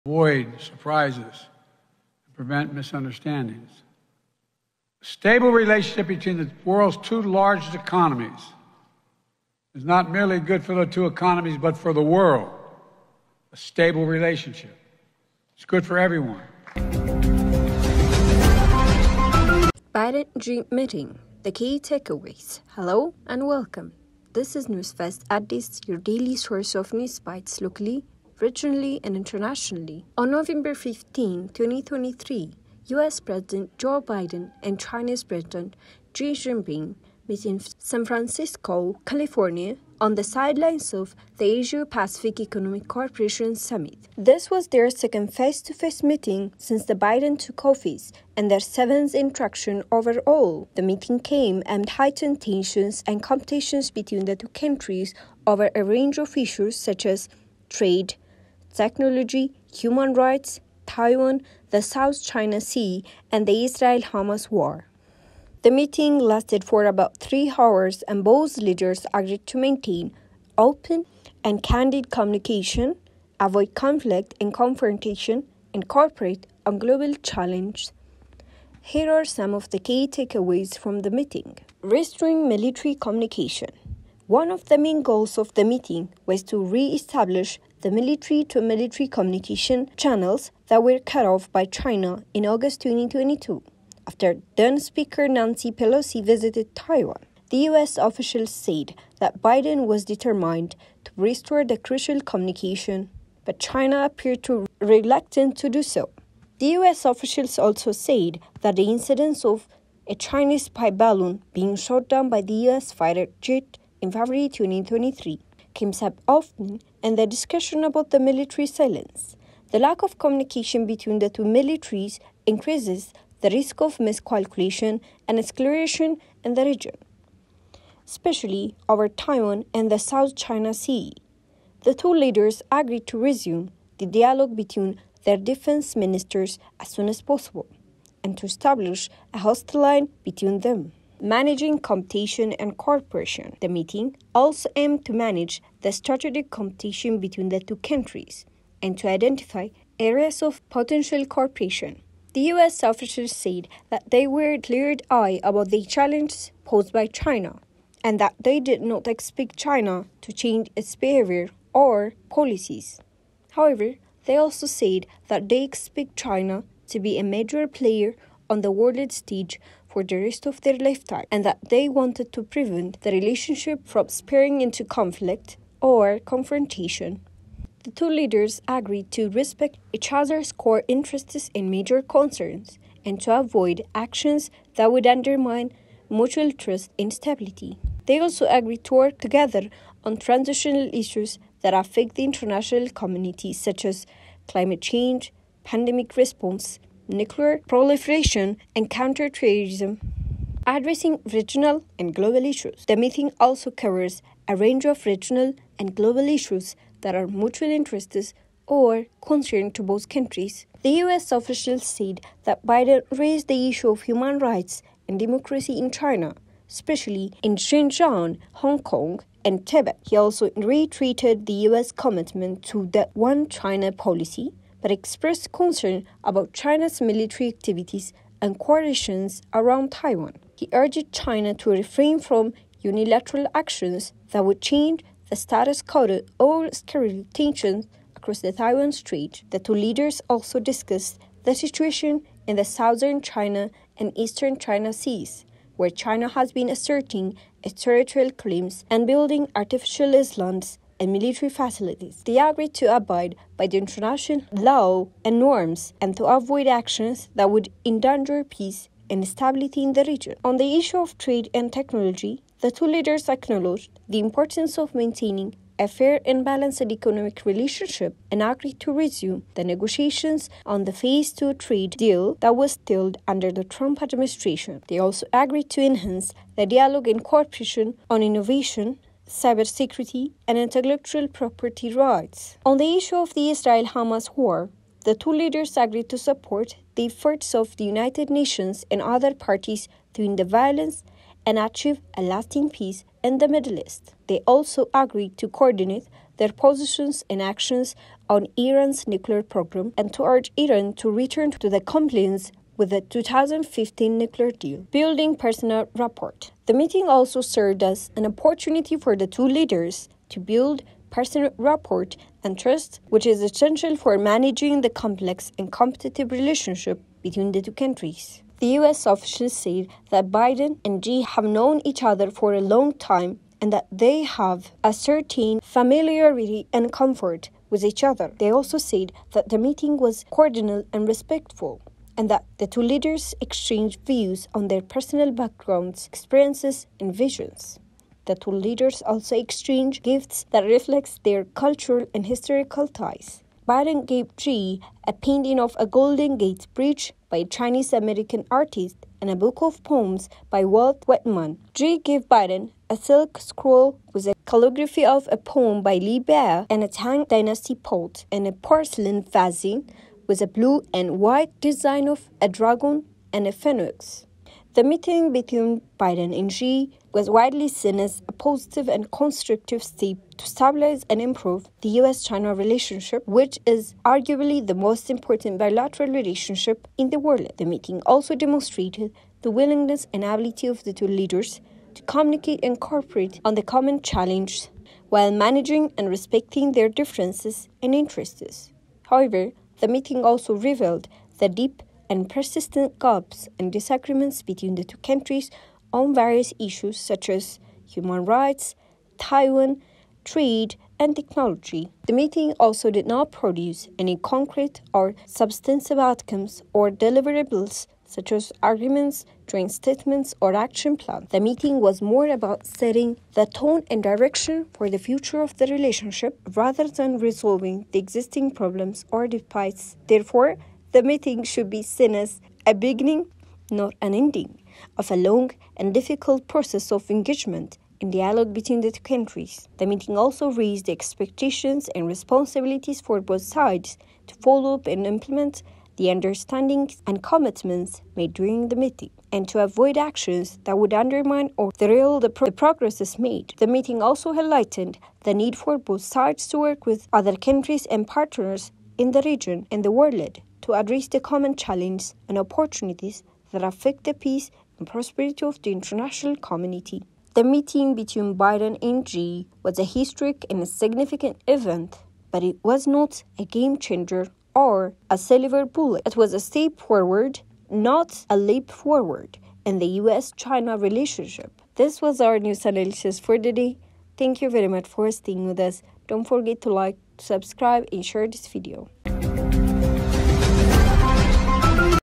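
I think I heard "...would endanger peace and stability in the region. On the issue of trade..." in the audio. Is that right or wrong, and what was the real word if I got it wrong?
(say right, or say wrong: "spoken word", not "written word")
right.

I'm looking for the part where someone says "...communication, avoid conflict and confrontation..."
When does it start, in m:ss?
1:12.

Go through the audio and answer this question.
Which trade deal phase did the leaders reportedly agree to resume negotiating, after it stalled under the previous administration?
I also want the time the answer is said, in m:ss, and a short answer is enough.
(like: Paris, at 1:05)
Phase 2, at 4:30.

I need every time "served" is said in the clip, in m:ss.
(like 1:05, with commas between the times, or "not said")
5:07.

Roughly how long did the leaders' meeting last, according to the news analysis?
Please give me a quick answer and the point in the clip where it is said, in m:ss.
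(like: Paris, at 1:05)
About three hours, at 1:06.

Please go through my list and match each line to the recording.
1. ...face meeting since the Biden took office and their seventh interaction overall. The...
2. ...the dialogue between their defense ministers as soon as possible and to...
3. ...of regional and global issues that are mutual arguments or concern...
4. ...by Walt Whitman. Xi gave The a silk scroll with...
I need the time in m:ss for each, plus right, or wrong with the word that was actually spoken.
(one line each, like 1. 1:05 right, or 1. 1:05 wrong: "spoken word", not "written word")
1. 0:45 right
2. 2:13 right
3. 3:24 wrong: "interests", not "arguments"
4. 5:50 wrong: "Biden", not "The".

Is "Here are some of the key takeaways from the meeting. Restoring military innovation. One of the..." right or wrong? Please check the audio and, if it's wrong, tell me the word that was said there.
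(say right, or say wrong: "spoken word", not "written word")
wrong: "communication", not "innovation".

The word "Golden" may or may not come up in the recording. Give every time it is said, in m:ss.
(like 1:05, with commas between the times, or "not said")
5:45.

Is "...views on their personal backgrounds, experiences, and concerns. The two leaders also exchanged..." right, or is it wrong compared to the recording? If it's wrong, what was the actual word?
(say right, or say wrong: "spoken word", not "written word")
wrong: "visions", not "concerns".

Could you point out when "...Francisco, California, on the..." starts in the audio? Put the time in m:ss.
0:38.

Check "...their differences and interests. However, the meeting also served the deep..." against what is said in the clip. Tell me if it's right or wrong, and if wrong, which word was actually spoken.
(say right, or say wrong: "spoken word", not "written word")
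wrong: "revealed", not "served".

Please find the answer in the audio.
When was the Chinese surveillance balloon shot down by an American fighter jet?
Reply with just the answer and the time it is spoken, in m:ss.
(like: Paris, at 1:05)
February 2023, at 1:54.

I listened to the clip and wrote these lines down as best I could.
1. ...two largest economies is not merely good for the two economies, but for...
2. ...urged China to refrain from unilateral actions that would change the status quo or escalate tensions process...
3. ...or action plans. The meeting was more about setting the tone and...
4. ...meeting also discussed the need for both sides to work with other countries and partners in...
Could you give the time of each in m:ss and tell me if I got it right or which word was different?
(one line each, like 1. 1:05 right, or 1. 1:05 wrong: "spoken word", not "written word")
1. 0:06 right
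2. 3:50 wrong: "across", not "process"
3. 6:50 right
4. 7:23 wrong: "highlighted", not "discussed".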